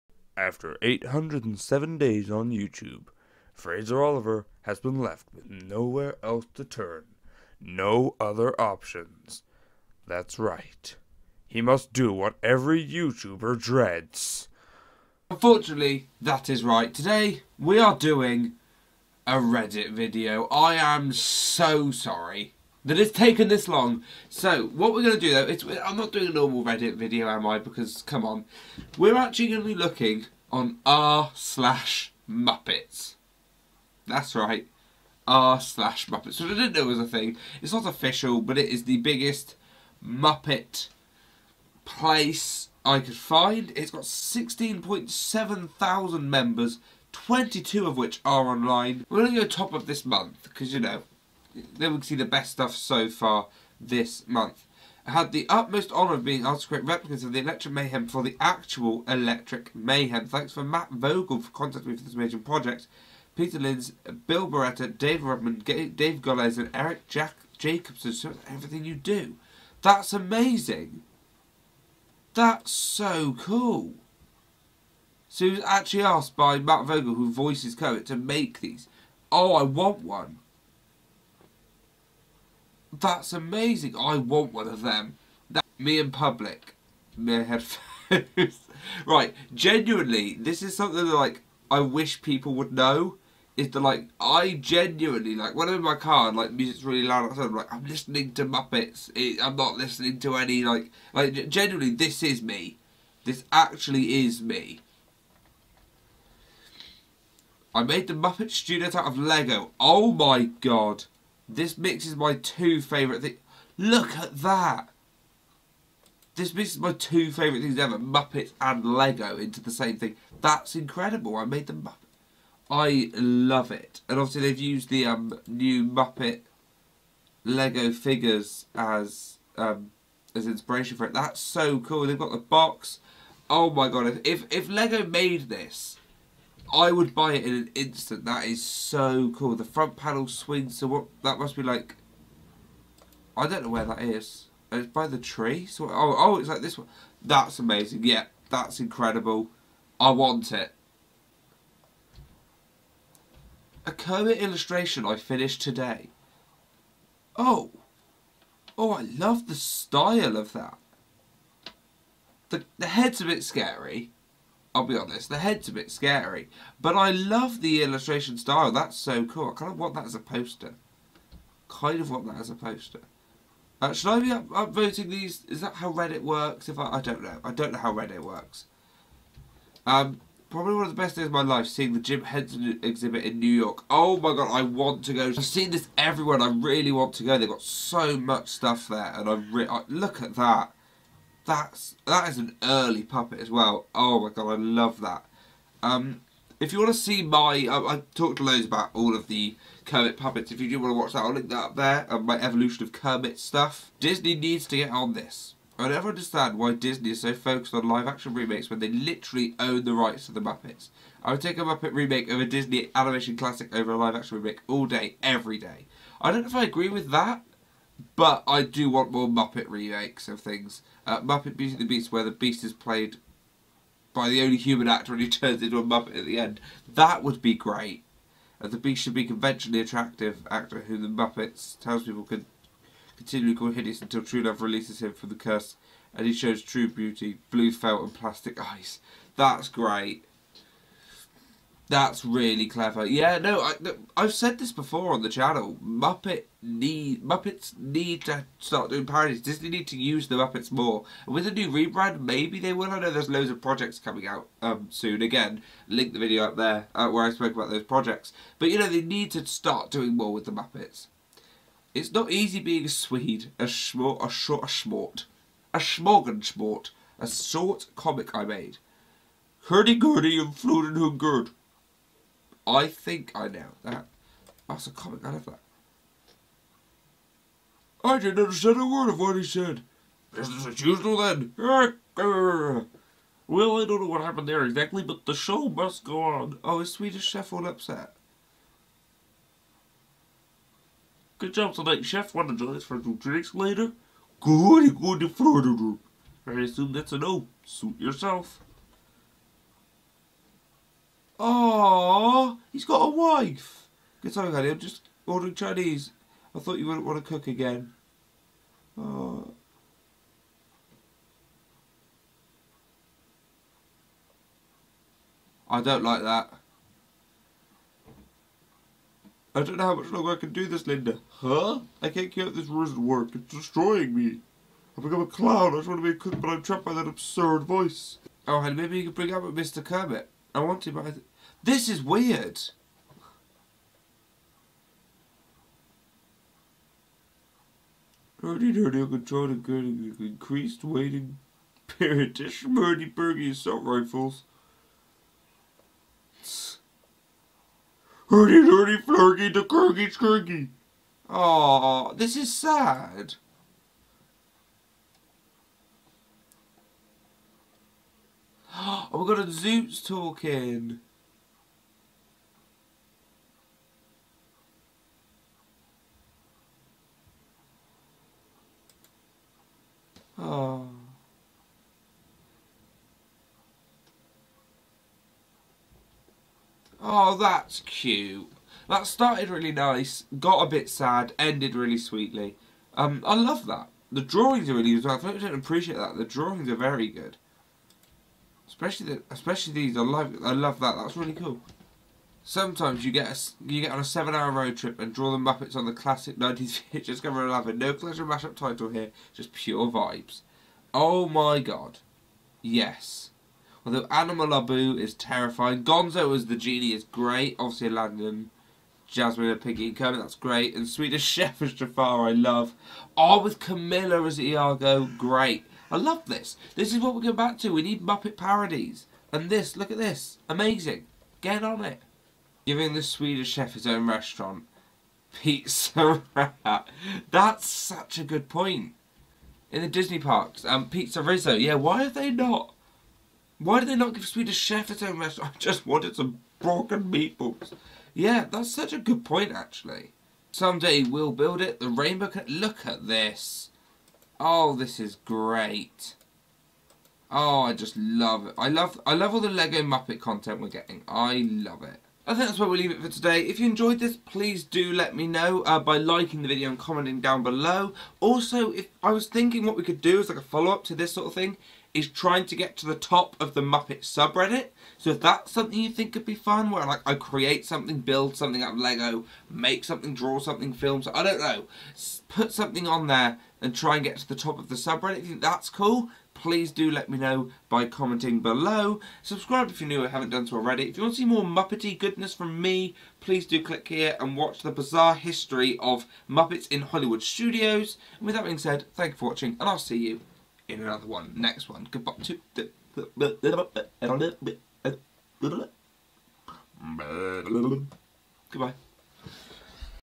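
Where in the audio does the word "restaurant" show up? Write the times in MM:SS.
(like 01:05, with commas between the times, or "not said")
07:04, 07:15.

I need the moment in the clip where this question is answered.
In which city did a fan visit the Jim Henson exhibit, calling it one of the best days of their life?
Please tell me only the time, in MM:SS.
03:03.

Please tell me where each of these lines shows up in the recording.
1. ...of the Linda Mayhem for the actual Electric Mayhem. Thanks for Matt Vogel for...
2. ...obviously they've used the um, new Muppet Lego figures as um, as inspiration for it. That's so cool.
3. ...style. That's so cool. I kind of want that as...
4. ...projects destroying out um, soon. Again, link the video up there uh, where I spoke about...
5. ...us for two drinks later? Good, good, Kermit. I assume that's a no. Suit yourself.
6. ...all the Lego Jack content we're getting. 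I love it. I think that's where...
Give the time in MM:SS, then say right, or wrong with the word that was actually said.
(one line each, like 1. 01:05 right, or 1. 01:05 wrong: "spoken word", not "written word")
1. 00:57 wrong: "Electric", not "Linda"
2. 02:04 right
3. 02:48 right
4. 04:13 wrong: "coming", not "destroying"
5. 04:52 wrong: "Florida", not "Kermit"
6. 07:29 wrong: "Muppet", not "Jack".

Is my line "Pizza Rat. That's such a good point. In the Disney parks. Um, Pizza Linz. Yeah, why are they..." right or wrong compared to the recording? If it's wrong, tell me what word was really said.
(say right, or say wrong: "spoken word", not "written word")
wrong: "Rizzo", not "Linz".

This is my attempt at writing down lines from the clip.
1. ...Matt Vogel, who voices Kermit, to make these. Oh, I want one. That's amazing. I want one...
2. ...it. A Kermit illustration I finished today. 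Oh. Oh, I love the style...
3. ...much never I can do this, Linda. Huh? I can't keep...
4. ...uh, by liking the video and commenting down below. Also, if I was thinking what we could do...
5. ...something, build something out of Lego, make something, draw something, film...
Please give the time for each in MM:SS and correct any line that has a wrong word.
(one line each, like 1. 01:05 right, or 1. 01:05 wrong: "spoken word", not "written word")
1. 01:16 right
2. 02:30 right
3. 05:19 wrong: "longer", not "never"
4. 07:35 right
5. 07:47 right.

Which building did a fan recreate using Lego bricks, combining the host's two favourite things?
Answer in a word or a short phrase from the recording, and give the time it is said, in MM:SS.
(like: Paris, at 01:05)
The Muppet Studio, at 01:48.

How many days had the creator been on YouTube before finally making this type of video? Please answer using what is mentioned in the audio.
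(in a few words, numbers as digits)
807.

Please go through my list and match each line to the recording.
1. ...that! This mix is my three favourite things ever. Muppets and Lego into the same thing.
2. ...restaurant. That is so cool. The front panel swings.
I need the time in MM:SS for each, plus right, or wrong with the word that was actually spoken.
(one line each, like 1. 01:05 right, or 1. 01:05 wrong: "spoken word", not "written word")
1. 01:54 wrong: "two", not "three"
2. 02:17 wrong: "instant", not "restaurant".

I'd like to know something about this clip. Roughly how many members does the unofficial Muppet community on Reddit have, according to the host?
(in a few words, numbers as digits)
16.7 thousand.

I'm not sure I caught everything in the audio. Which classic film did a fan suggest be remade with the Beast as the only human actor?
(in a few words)
Beauty and the Beast.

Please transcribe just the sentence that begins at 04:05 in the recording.
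Muppet need Muppets need to start doing parodies.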